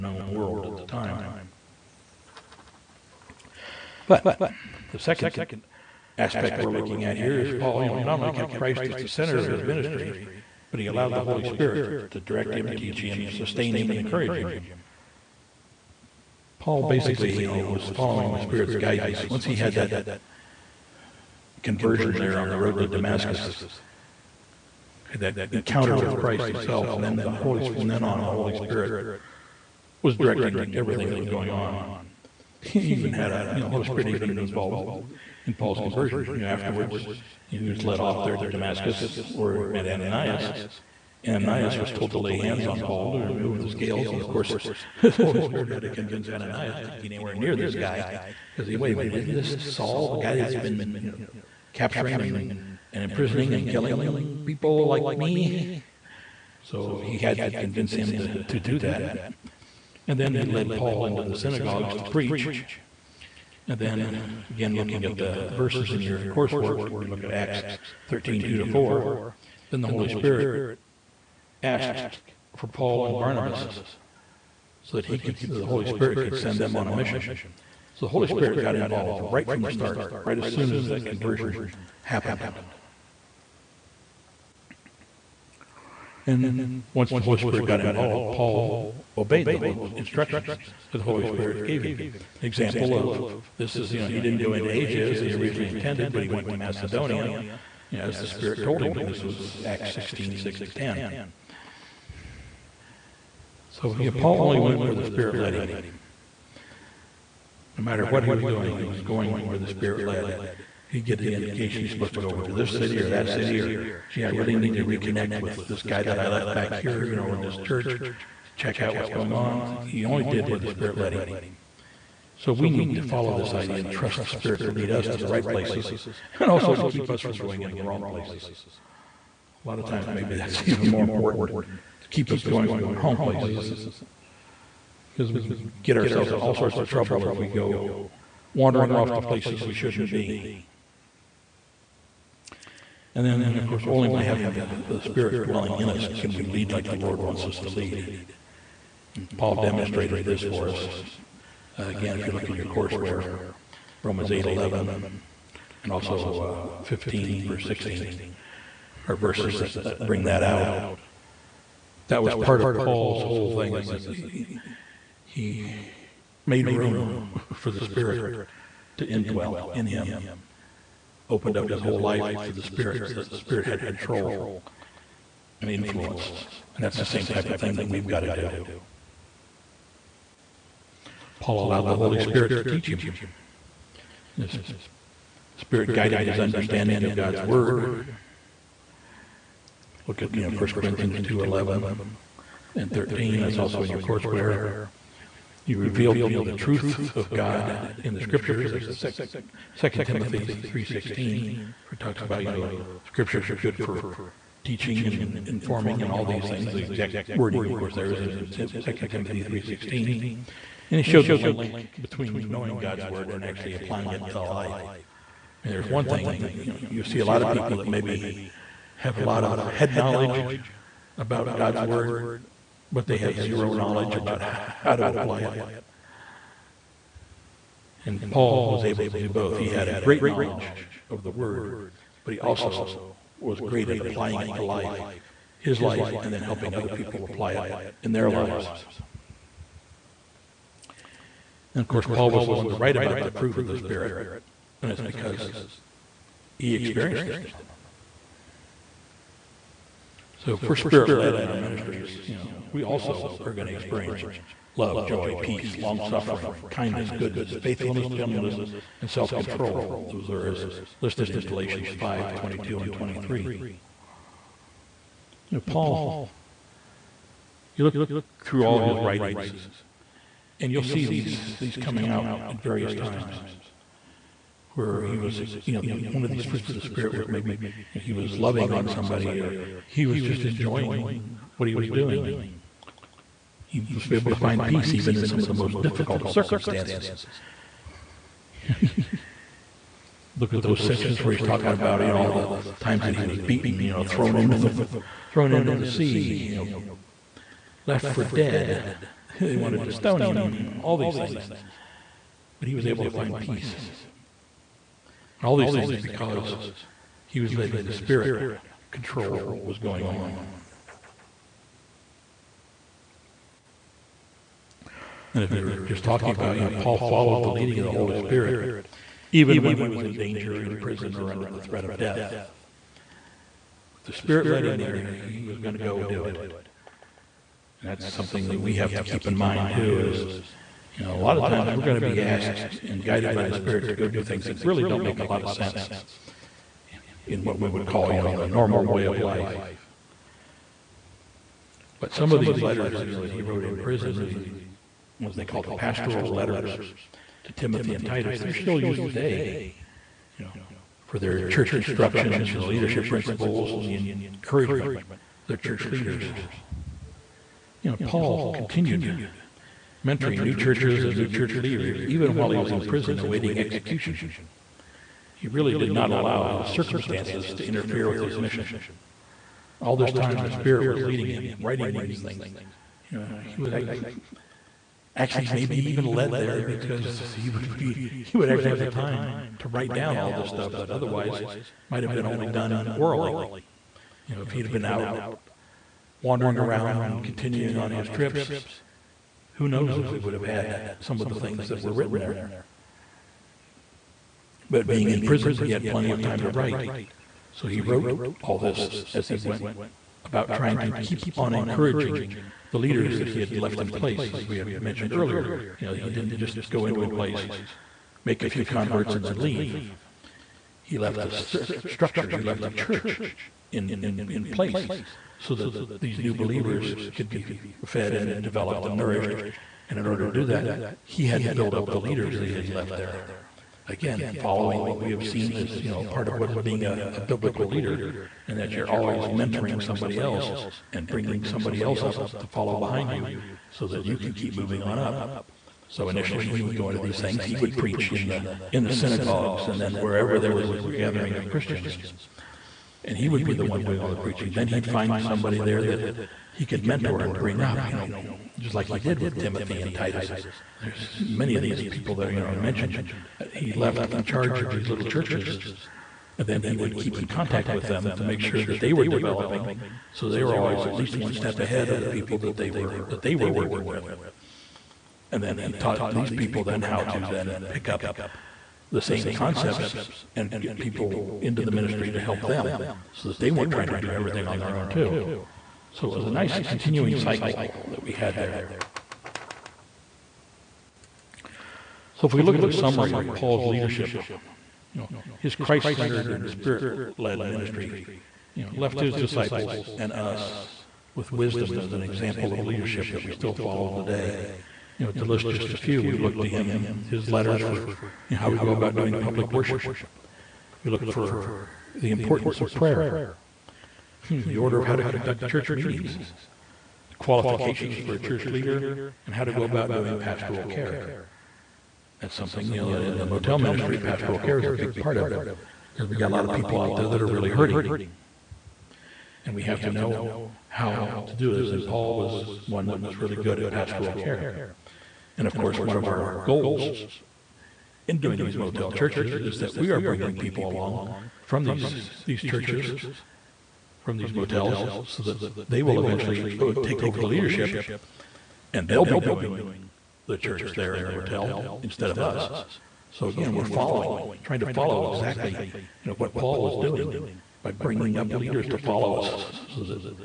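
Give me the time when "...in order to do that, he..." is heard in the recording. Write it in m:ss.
6:59.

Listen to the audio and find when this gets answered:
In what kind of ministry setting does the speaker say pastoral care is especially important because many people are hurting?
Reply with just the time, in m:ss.
8:33.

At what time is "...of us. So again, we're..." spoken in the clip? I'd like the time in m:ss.
9:02.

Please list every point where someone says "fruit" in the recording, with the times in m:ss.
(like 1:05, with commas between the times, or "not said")
4:03, 4:36.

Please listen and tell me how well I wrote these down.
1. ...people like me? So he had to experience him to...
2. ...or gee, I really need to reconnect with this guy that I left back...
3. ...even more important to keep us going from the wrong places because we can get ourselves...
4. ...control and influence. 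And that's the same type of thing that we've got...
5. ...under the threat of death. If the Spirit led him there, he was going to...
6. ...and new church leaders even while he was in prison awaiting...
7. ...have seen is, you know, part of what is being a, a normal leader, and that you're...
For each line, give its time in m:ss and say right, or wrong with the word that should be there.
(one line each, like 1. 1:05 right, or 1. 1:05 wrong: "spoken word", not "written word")
1. 0:54 wrong: "convince", not "experience"
2. 1:53 right
3. 2:10 right
4. 2:53 right
5. 5:21 right
6. 6:01 right
7. 7:05 wrong: "biblical", not "normal".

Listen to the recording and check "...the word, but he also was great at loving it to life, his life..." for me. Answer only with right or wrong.
wrong.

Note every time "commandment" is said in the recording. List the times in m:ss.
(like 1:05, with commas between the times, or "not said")
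not said.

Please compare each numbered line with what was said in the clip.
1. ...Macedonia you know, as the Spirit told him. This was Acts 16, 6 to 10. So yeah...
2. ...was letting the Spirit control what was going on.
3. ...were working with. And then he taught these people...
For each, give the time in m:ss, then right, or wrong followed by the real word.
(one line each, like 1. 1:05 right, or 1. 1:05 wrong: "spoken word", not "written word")
1. 1:36 right
2. 5:07 right
3. 7:43 right.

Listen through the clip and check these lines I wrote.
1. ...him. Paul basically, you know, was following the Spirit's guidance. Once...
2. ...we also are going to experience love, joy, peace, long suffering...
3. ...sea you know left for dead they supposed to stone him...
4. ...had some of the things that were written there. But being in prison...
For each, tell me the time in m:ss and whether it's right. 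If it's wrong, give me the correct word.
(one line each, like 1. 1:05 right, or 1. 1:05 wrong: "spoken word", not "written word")
1. 0:14 right
2. 4:12 right
3. 4:55 wrong: "wanted", not "supposed"
4. 6:30 right.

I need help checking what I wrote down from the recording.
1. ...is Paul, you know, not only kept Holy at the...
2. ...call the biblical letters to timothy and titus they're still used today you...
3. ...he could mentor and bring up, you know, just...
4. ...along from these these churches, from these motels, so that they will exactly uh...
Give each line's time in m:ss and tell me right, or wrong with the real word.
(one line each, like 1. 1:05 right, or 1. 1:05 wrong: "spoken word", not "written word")
1. 0:07 wrong: "Christ", not "Holy"
2. 5:45 wrong: "pastoral", not "biblical"
3. 7:26 right
4. 8:50 wrong: "eventually", not "exactly".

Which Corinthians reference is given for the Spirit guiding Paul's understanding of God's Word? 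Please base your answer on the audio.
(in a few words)
1 Corinthians 2:11.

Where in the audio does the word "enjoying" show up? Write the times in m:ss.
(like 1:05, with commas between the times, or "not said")
4:40.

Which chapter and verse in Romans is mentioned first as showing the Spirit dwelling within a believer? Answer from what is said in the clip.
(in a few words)
Romans 8:11.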